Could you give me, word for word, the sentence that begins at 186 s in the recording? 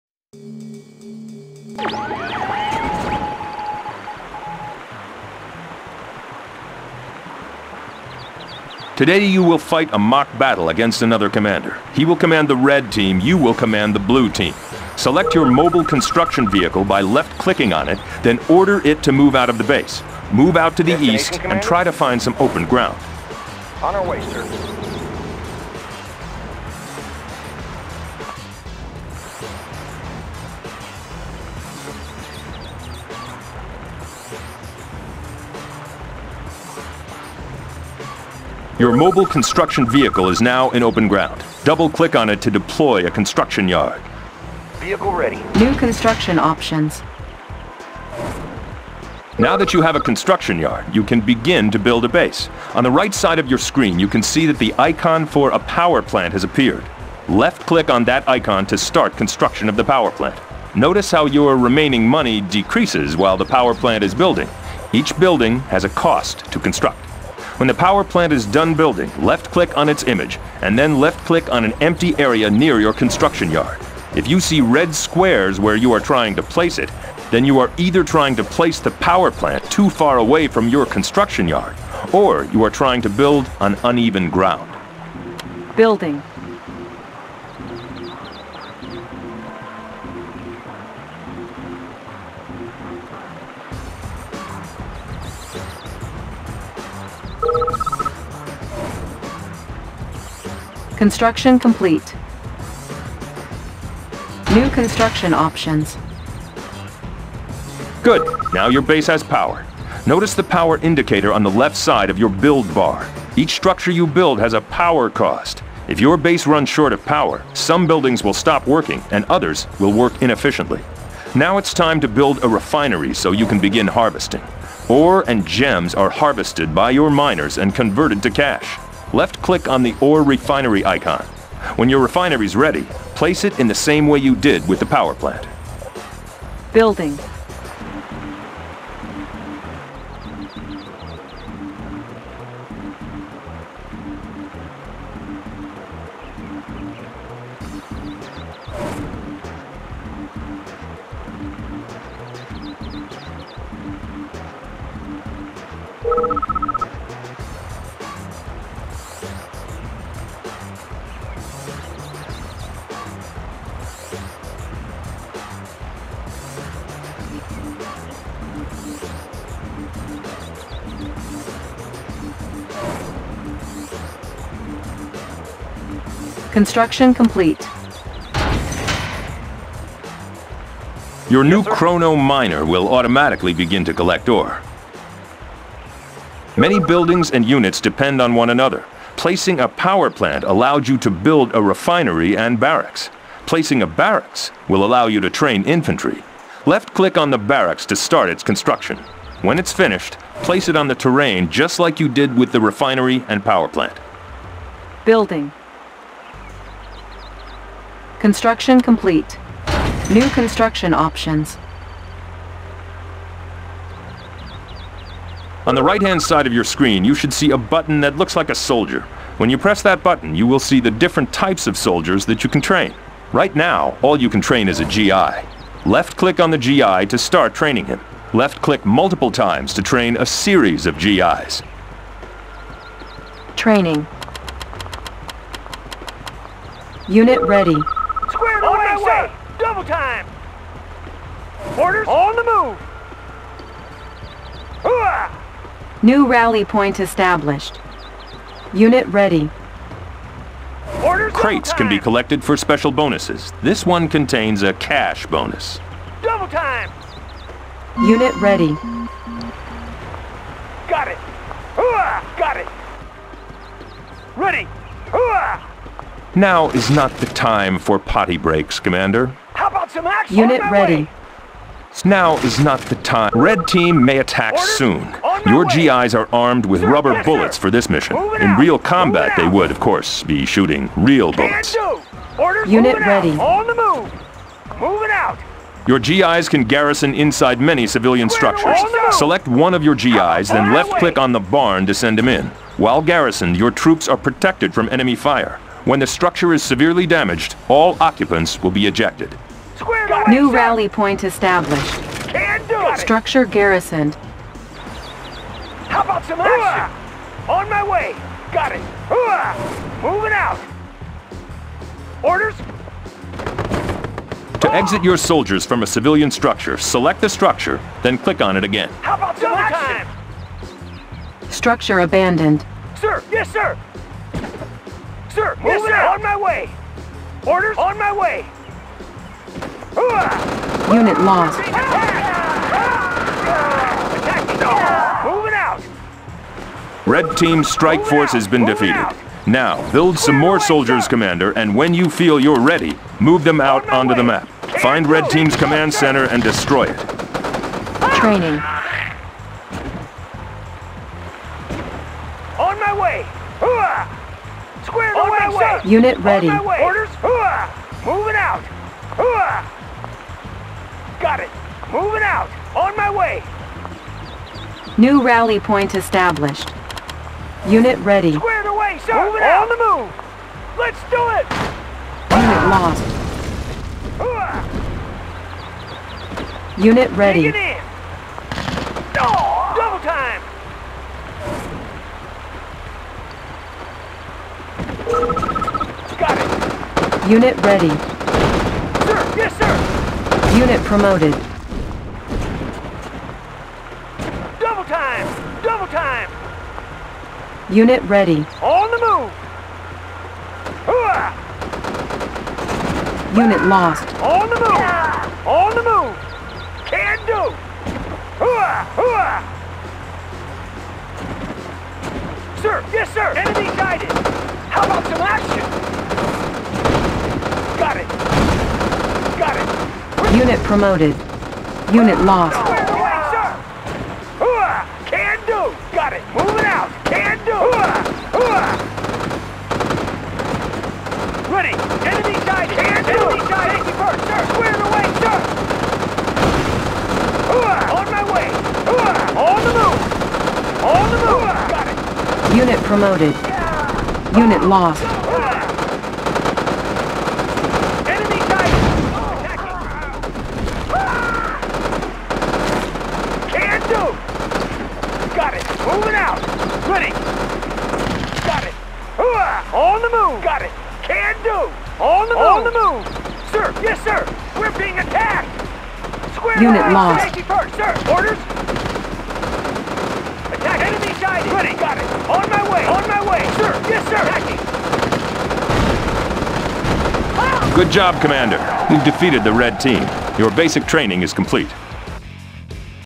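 Many buildings and units depend on one another.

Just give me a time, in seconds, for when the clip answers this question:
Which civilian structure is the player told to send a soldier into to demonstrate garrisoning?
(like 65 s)
291 s.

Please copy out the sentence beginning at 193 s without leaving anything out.
Placing a barracks will allow you to train infantry.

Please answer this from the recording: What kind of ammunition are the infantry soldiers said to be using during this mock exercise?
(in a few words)
Rubber bullets.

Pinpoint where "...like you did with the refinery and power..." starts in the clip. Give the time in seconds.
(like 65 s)
201 s.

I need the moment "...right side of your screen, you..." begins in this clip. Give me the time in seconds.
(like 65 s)
52 s.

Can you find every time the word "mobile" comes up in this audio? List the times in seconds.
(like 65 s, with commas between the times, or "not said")
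15 s, 38 s.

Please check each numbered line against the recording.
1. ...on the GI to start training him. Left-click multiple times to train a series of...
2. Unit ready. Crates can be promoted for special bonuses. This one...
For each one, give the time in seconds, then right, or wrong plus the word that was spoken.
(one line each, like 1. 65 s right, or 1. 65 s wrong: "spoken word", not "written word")
1. 226 s right
2. 248 s wrong: "collected", not "promoted".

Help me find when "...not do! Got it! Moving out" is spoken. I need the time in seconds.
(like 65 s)
453 s.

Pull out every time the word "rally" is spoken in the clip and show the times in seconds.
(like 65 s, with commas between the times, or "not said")
246 s, 300 s, 365 s.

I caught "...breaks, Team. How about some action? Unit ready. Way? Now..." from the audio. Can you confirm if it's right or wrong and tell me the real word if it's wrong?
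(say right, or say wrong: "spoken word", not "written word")
wrong: "Commander", not "Team".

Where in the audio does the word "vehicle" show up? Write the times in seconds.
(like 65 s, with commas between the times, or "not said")
16 s, 39 s, 44 s.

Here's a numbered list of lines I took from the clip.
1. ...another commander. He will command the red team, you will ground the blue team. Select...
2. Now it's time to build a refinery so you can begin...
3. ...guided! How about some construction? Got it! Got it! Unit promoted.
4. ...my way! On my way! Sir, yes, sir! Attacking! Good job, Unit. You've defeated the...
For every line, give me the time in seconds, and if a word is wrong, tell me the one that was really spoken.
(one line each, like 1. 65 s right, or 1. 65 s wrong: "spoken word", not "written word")
1. 11 s wrong: "command", not "ground"
2. 121 s right
3. 413 s wrong: "action", not "construction"
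4. 472 s wrong: "Commander", not "Unit".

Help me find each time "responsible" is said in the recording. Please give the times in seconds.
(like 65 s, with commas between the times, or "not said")
not said.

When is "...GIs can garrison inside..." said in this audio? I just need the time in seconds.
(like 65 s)
285 s.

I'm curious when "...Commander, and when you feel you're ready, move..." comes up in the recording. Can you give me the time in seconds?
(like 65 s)
341 s.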